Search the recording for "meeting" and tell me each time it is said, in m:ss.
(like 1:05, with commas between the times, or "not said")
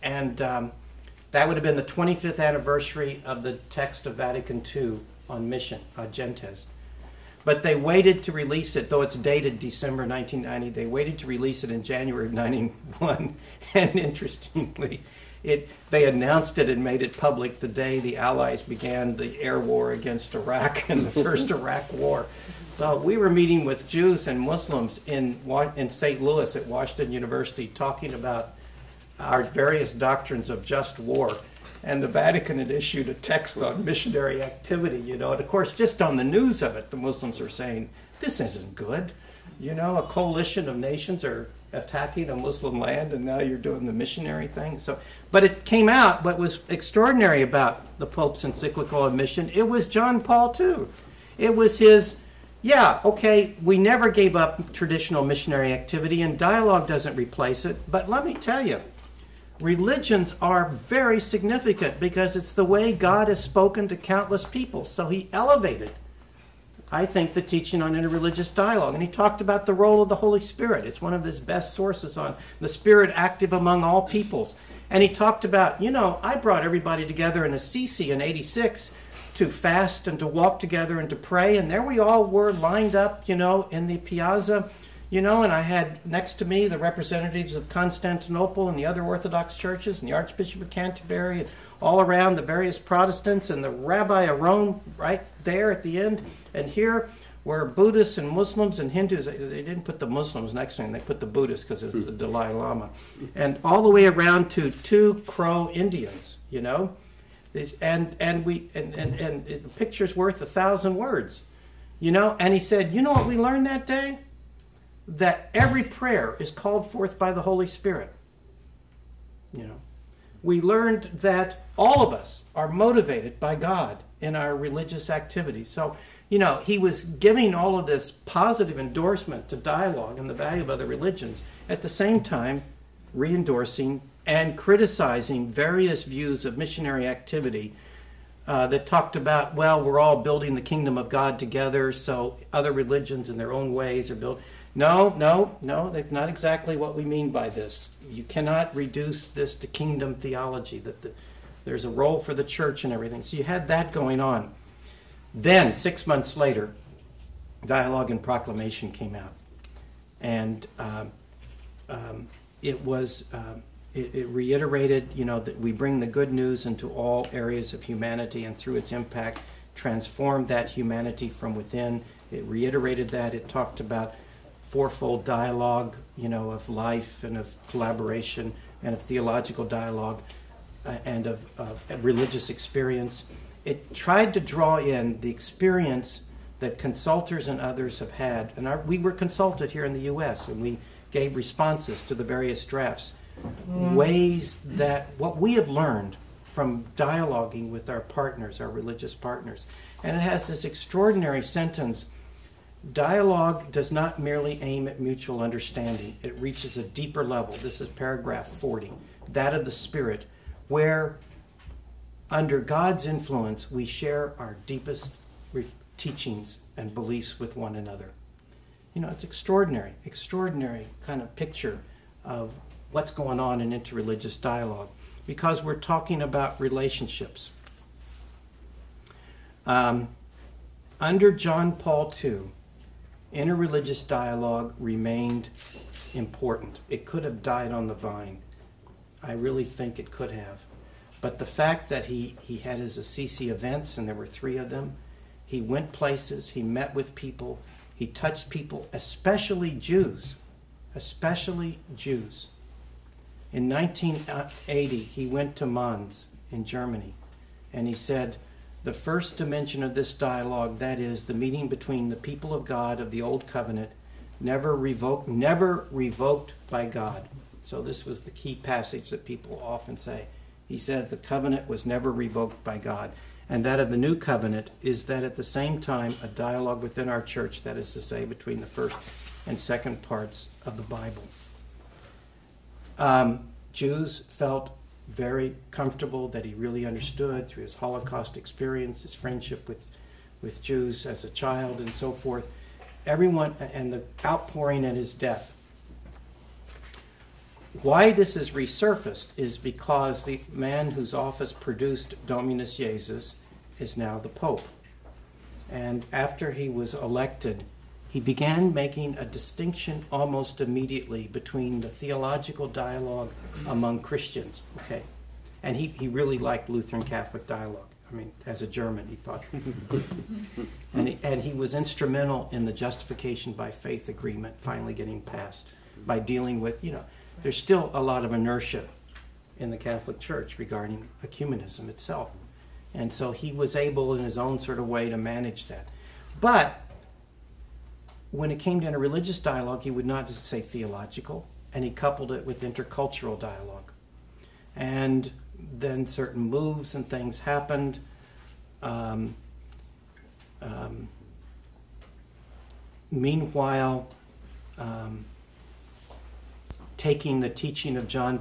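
0:23, 4:21.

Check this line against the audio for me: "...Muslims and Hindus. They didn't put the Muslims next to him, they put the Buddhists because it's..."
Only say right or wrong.
right.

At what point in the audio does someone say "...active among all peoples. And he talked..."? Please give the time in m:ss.
1:13.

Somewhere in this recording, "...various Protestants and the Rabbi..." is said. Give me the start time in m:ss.
1:32.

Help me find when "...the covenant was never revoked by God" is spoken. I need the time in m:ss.
4:31.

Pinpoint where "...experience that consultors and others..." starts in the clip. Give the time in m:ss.
3:05.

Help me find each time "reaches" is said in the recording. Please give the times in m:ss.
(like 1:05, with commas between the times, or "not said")
3:26.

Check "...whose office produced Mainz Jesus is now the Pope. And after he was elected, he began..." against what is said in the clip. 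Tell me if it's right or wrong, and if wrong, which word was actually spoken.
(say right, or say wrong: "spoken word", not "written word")
wrong: "Dominus", not "Mainz".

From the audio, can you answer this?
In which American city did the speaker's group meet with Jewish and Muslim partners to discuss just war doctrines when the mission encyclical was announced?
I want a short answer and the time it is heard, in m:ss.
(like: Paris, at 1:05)
St. Louis, at 0:25.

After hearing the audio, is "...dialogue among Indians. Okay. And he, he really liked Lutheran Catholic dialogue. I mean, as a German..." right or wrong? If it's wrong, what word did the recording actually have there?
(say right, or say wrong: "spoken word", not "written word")
wrong: "Christians", not "Indians".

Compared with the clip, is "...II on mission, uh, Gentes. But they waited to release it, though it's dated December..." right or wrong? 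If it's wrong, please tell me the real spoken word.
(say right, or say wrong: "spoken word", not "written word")
right.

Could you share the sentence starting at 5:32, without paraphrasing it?
And so he was able, in his own sort of way, to manage that.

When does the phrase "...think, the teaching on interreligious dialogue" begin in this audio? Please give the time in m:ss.
1:07.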